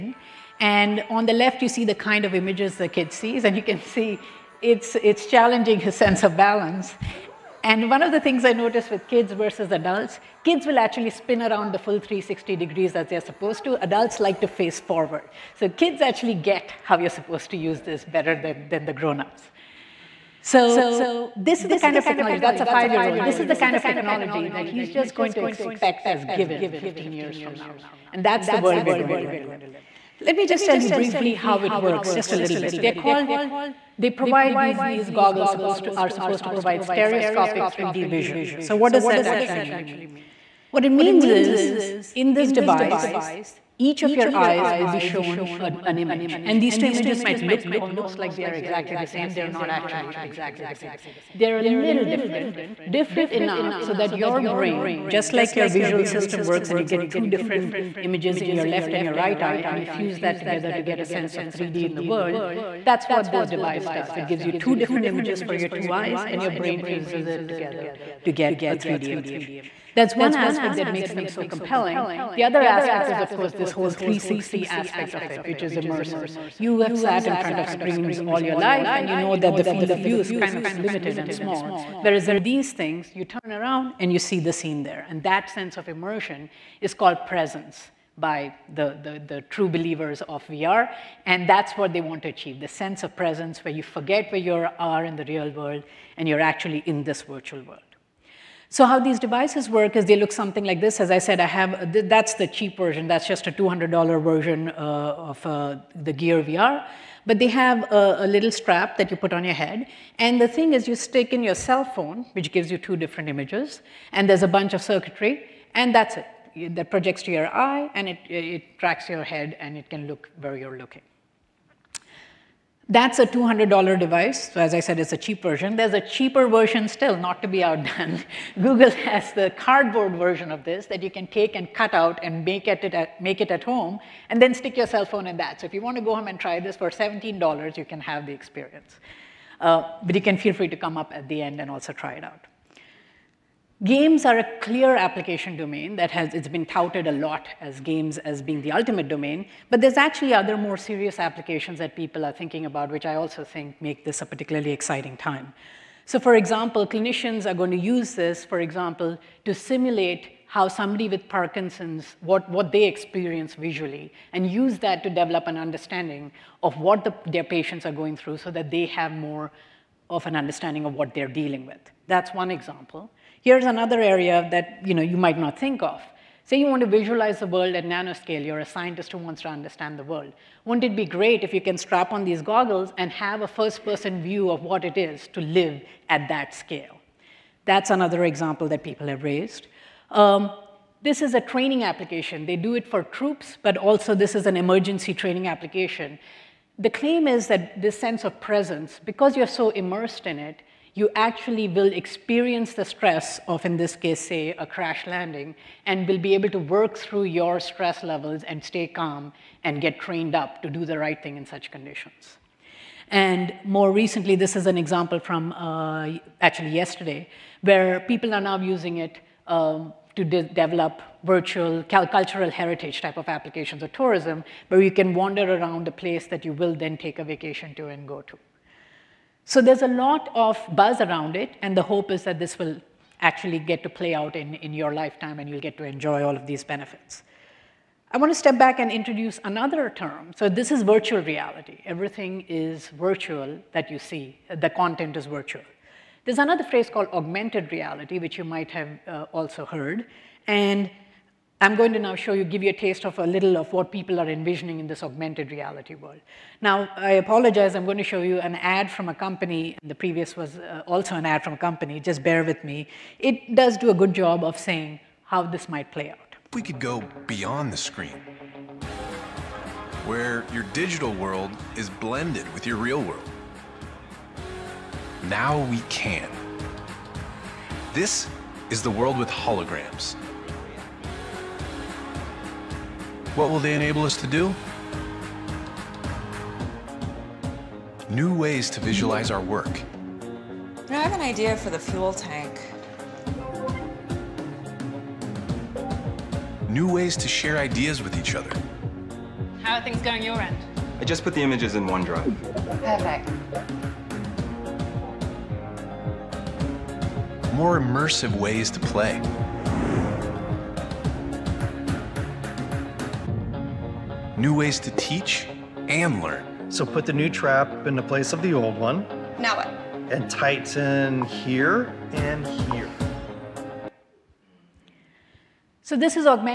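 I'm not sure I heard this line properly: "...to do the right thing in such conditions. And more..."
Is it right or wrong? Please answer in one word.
right.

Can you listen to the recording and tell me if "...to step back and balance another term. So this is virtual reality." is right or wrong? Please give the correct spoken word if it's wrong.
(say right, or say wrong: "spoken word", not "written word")
wrong: "introduce", not "balance".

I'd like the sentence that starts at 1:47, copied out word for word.
But they have a, a, little strap that you put on your head.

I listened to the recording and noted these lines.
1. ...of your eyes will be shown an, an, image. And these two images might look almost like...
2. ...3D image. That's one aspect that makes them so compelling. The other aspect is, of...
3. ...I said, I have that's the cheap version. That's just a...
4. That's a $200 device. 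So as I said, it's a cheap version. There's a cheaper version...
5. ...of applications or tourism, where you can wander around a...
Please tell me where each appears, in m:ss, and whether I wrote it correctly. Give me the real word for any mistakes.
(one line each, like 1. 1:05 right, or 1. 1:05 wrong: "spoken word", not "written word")
1. 0:44 right
2. 1:08 right
3. 1:41 right
4. 2:02 right
5. 3:43 right.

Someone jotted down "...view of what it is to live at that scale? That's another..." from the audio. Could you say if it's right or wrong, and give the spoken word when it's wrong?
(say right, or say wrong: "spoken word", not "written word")
right.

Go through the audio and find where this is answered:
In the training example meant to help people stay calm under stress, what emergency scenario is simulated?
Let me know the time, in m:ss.
3:24.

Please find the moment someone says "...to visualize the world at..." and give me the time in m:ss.
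2:56.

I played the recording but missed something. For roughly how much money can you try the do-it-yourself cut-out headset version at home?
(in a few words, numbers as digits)
$17.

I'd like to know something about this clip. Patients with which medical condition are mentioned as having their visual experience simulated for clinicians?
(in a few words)
Parkinson's.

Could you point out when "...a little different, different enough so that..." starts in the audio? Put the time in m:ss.
0:51.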